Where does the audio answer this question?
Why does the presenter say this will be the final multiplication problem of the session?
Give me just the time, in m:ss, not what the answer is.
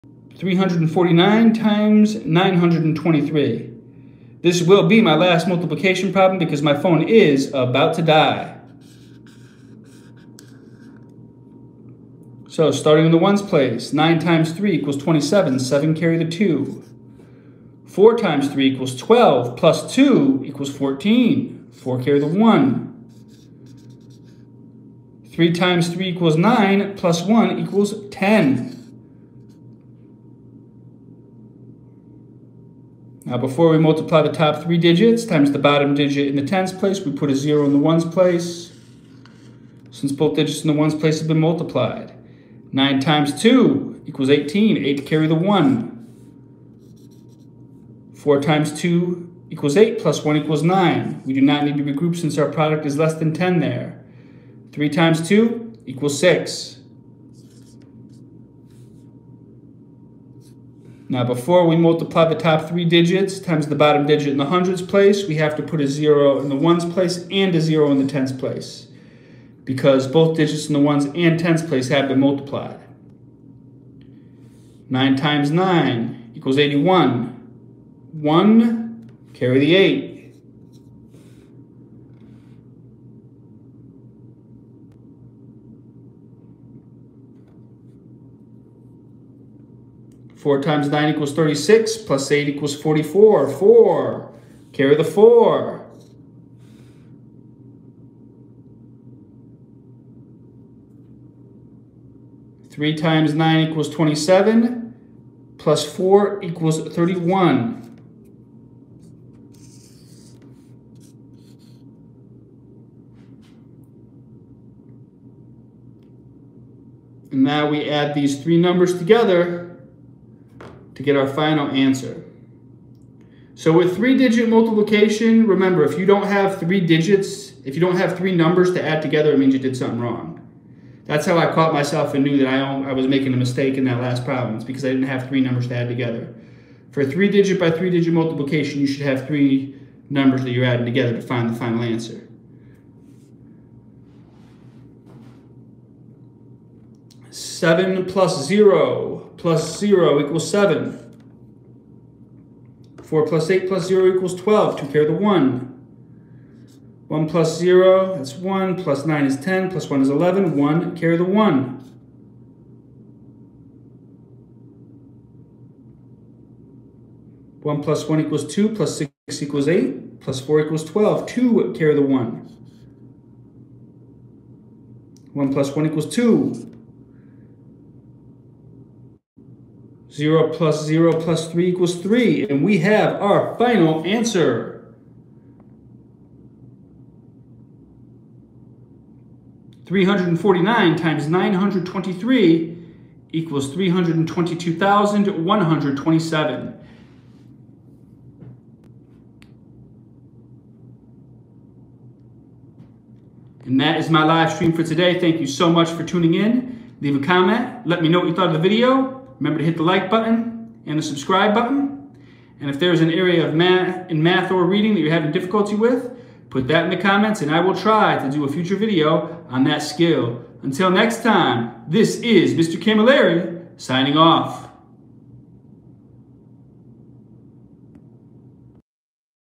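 0:06.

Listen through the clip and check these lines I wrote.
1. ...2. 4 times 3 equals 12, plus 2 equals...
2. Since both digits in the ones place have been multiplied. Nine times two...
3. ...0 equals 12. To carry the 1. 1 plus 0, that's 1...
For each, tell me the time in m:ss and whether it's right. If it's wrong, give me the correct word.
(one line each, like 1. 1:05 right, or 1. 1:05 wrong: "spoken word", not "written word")
1. 0:16 right
2. 0:39 right
3. 2:33 right.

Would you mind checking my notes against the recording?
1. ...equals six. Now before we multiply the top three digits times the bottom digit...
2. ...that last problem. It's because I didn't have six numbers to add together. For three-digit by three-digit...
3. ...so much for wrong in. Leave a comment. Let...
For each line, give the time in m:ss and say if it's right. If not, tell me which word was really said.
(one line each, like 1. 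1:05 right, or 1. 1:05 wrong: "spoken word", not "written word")
1. 0:55 right
2. 2:13 wrong: "three", not "six"
3. 3:25 wrong: "tuning", not "wrong".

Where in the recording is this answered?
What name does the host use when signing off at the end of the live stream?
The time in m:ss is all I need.
3:42.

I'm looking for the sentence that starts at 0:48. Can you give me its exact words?
Four times two equals eight plus one equals nine.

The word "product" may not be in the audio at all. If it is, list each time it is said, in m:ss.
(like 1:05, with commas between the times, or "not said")
0:52.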